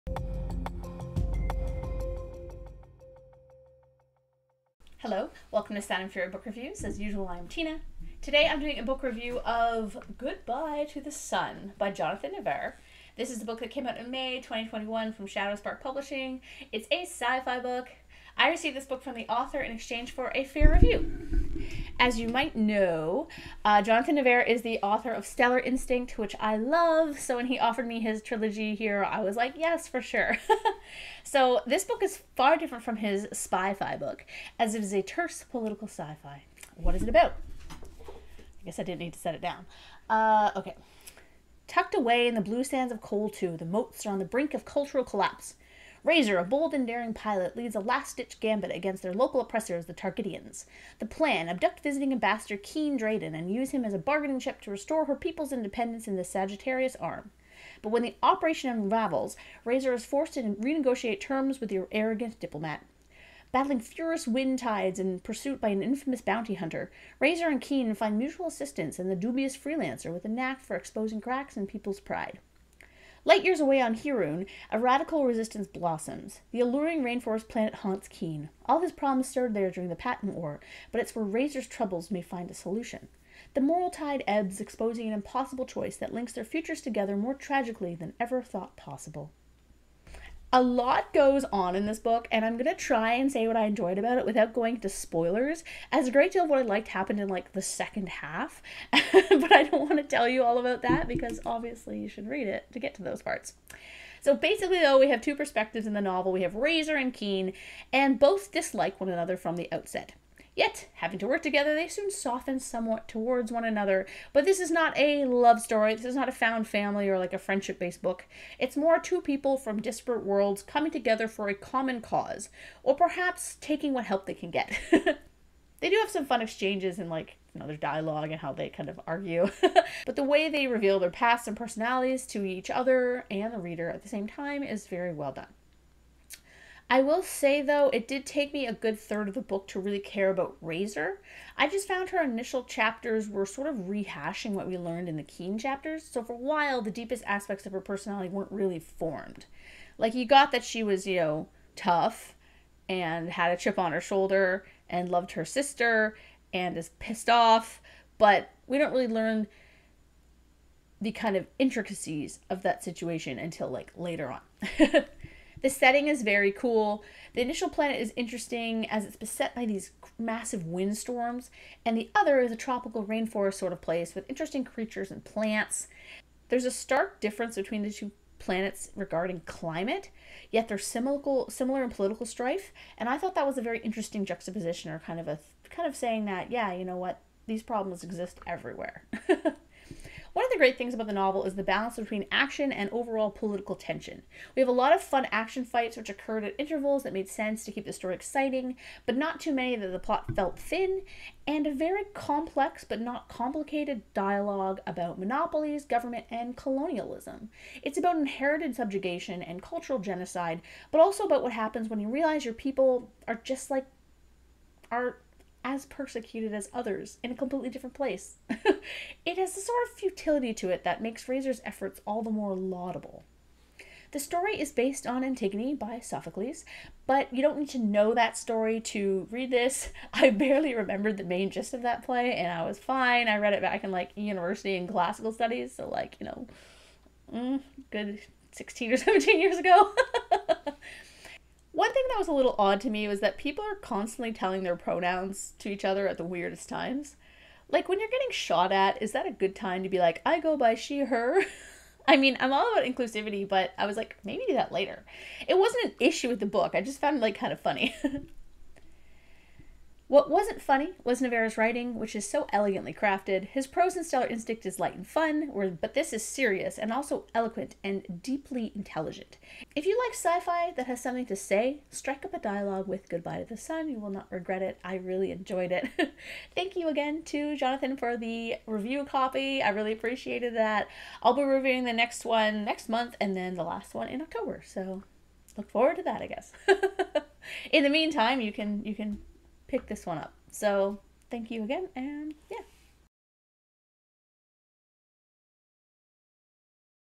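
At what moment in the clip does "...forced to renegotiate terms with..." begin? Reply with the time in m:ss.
1:00.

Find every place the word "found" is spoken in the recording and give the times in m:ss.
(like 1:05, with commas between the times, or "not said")
1:56, 2:21, 4:16.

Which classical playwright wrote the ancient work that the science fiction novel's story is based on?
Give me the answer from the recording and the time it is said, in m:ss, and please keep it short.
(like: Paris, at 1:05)
Sophocles, at 3:46.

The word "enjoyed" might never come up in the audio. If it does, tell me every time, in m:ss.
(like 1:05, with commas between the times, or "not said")
1:33, 4:35.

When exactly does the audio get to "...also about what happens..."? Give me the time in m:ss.
3:31.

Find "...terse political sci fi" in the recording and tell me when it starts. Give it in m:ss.
0:35.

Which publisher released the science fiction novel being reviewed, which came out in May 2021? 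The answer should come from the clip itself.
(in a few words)
Shadow Spark Publishing.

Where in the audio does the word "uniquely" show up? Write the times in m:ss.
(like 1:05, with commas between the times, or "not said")
not said.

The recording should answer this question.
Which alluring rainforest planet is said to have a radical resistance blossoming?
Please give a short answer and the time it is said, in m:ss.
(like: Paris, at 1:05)
Hirun, at 1:13.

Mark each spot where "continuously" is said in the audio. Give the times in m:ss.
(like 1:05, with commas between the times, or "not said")
not said.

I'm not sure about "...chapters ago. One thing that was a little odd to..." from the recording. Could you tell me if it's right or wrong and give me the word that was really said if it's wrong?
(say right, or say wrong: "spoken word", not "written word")
wrong: "years", not "chapters".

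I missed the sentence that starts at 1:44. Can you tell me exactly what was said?
So basically, though, we have two perspectives in the novel.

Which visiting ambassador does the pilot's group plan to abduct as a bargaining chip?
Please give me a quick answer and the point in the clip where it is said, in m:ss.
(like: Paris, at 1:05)
Keen Drayden, at 0:52.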